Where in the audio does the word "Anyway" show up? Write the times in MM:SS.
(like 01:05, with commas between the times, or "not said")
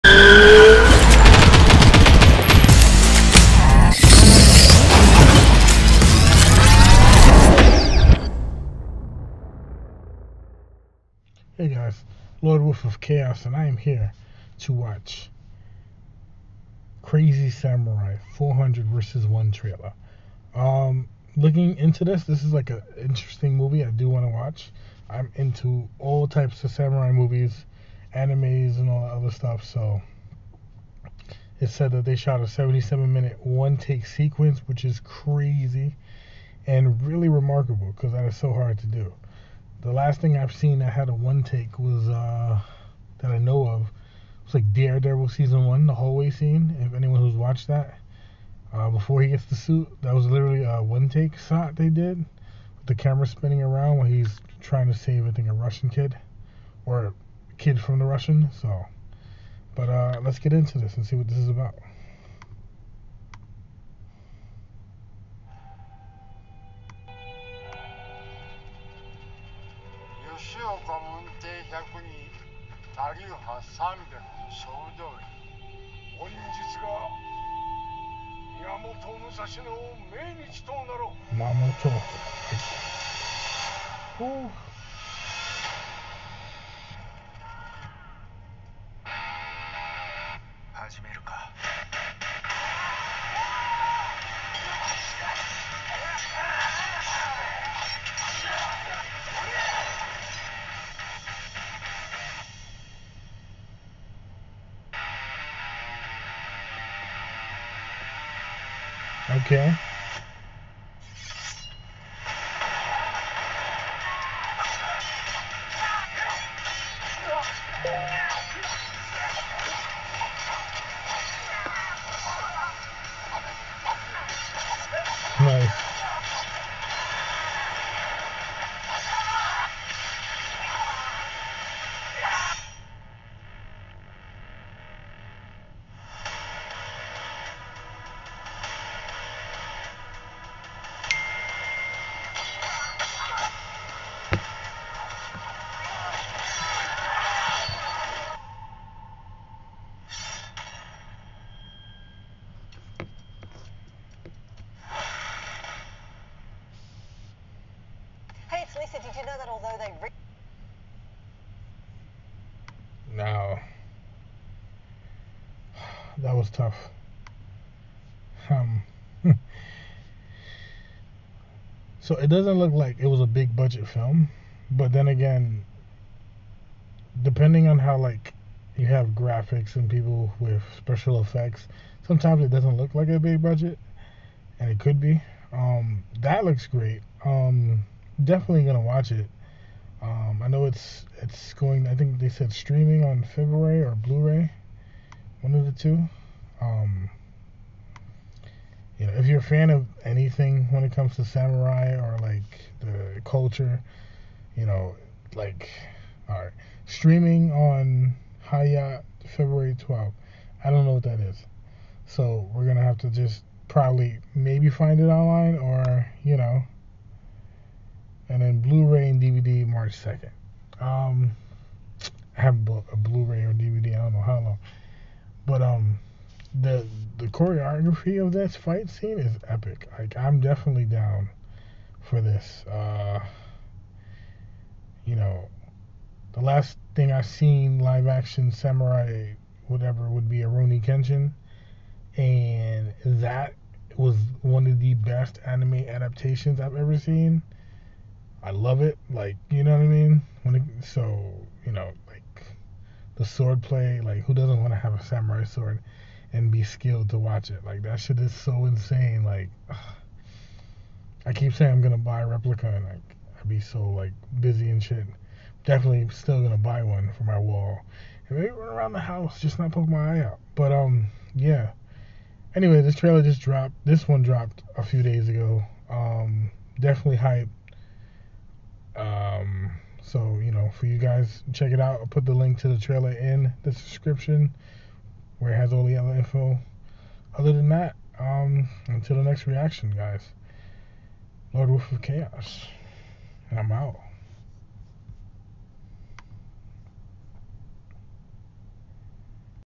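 04:32.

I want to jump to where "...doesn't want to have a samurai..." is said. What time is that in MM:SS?
04:14.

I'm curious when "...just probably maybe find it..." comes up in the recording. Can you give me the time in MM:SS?
03:33.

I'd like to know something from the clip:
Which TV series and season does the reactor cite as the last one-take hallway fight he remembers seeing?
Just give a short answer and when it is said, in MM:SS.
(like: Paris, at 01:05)
Daredevil season one, at 00:44.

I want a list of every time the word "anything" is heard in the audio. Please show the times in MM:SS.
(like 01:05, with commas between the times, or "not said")
03:20.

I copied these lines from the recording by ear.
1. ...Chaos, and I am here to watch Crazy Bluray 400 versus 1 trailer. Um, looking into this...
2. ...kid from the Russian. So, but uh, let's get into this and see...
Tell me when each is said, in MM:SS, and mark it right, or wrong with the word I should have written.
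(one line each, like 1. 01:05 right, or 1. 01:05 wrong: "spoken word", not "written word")
1. 00:12 wrong: "Samurai", not "Bluray"
2. 00:57 right.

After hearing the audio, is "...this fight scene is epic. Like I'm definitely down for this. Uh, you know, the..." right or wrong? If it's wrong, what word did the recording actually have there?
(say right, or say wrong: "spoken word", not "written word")
right.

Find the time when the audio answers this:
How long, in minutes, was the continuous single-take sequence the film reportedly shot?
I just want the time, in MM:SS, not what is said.
00:32.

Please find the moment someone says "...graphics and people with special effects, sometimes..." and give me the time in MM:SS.
02:59.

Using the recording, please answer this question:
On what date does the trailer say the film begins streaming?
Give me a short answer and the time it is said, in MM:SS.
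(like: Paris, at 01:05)
February 12th, at 03:29.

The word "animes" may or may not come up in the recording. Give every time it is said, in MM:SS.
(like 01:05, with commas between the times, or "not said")
00:28, 04:05.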